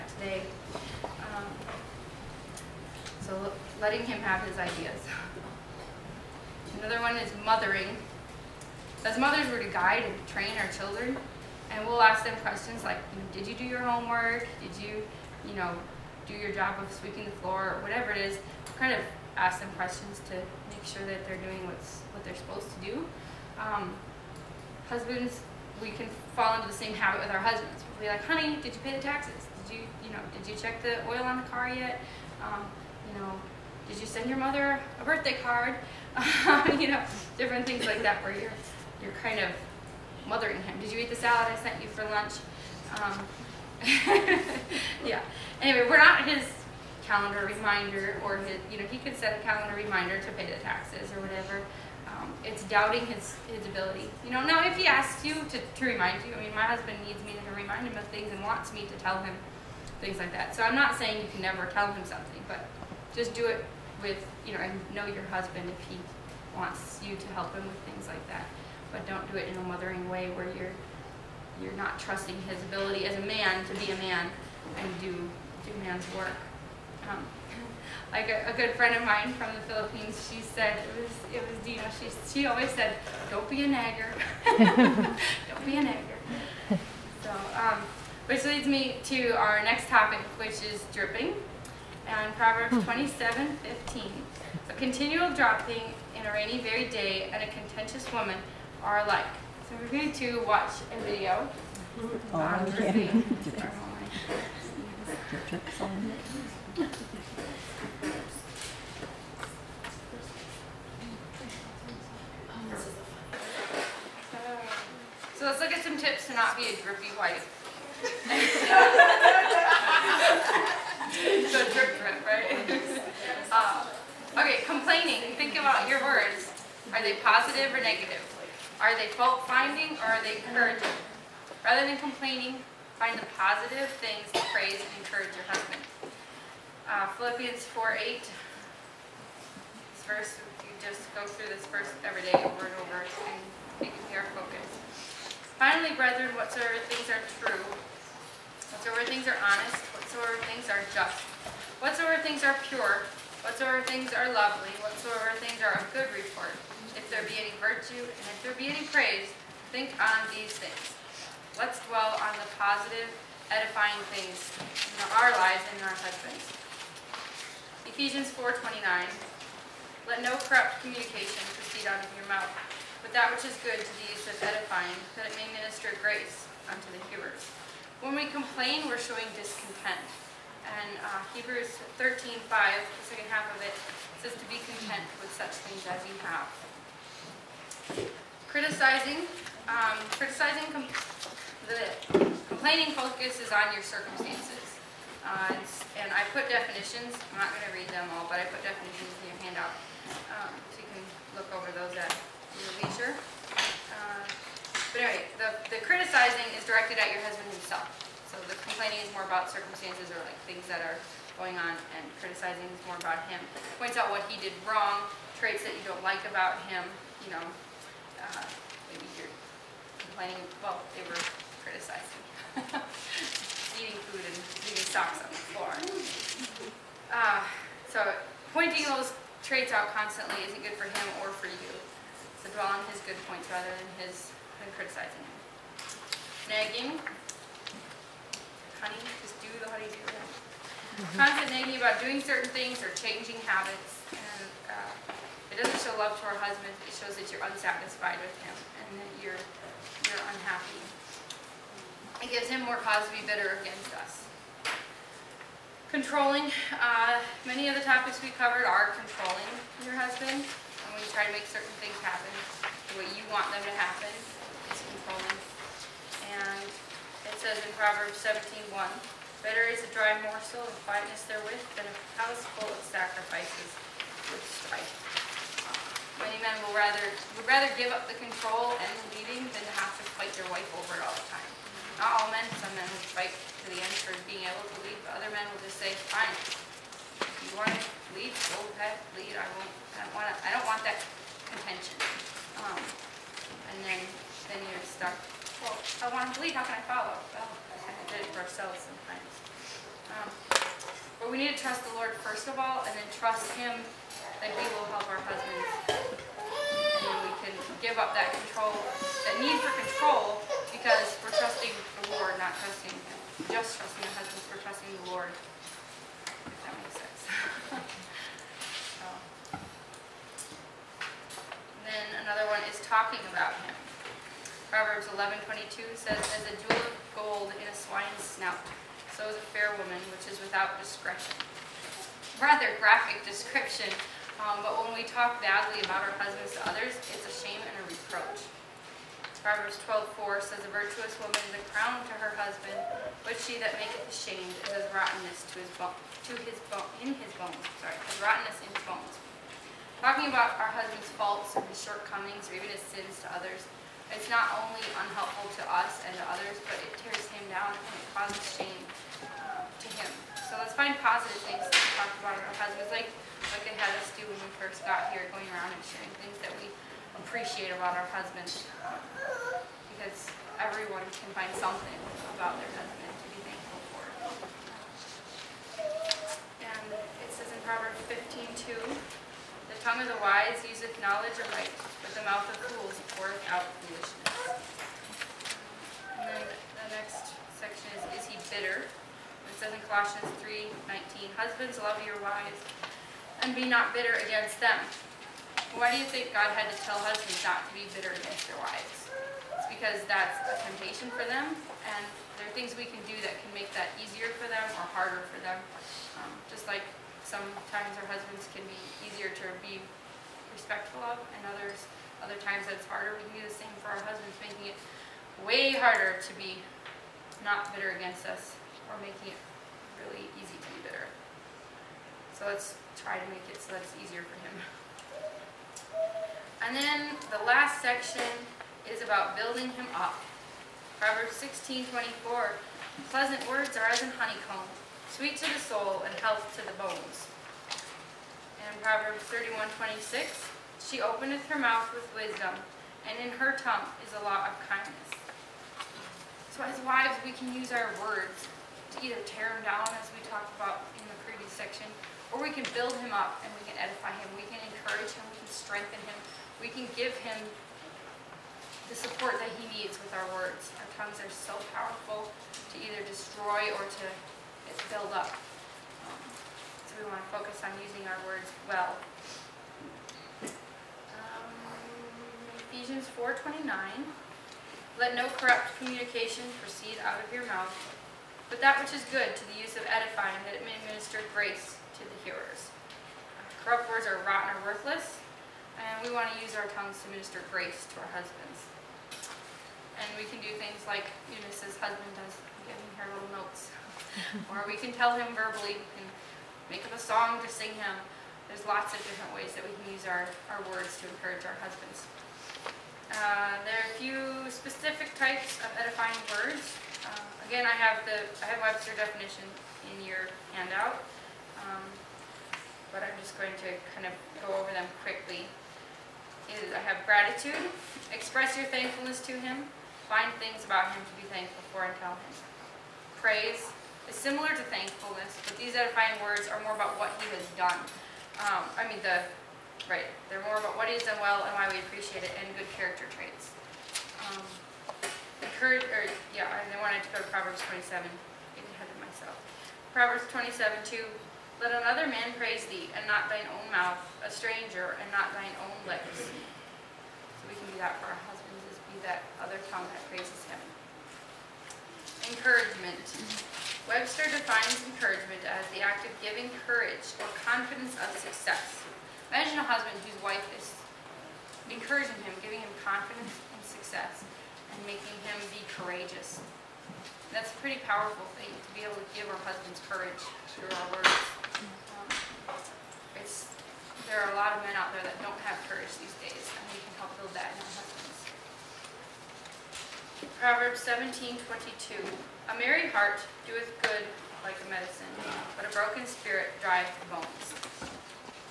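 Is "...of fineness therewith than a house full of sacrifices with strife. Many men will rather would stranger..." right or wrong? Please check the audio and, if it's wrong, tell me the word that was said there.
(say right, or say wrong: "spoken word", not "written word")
wrong: "rather", not "stranger".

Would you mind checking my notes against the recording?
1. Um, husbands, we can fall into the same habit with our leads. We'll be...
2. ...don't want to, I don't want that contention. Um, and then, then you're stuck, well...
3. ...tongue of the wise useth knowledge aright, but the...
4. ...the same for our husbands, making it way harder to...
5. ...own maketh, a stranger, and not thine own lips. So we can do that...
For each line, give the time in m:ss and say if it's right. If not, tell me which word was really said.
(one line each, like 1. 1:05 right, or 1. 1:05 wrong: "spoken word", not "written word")
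1. 0:23 wrong: "husbands", not "leads"
2. 4:50 right
3. 6:19 right
4. 6:53 right
5. 9:03 wrong: "mouth", not "maketh".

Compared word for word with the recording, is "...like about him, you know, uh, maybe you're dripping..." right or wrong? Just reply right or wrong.
wrong.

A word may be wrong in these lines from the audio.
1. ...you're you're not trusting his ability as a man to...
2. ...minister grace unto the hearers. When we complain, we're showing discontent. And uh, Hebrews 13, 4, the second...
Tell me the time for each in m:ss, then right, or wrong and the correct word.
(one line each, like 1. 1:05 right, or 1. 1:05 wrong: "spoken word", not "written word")
1. 1:10 right
2. 2:55 wrong: "5", not "4".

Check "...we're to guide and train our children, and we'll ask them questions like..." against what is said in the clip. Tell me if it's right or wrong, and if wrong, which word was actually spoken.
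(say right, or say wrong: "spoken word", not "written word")
right.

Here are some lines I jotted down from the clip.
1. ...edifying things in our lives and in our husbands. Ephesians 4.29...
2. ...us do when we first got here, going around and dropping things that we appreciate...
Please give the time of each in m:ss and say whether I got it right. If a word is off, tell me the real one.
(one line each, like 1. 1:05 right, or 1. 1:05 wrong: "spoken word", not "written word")
1. 2:43 right
2. 6:04 wrong: "sharing", not "dropping".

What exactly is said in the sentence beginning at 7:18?
And in Proverbs 31, 26, she openeth her mouth with wisdom, and in her tongue is a lot of kindness.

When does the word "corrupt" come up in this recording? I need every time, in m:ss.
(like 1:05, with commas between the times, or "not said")
2:50, 7:55, 8:03.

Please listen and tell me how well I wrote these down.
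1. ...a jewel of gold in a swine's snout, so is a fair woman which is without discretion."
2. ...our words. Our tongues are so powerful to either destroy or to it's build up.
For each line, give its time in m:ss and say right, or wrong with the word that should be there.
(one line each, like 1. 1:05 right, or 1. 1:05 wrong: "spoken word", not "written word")
1. 5:26 right
2. 7:40 right.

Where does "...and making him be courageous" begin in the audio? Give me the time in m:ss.
9:24.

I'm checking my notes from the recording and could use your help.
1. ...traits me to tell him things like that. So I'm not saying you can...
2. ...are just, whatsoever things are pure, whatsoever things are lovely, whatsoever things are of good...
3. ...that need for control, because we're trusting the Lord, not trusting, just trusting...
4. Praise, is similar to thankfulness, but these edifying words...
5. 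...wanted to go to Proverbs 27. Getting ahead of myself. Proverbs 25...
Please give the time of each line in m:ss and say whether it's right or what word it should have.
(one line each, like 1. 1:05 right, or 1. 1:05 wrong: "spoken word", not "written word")
1. 0:58 wrong: "wants", not "traits"
2. 2:30 right
3. 5:08 right
4. 8:43 right
5. 8:56 wrong: "27", not "25".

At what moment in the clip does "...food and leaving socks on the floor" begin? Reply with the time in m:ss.
3:44.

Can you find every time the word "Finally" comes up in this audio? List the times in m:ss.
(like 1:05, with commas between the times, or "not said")
2:25.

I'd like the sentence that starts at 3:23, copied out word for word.
Uh, but anyway, the, the criticizing is directed at your husband himself.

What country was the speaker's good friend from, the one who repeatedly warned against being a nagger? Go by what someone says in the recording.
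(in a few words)
Philippines.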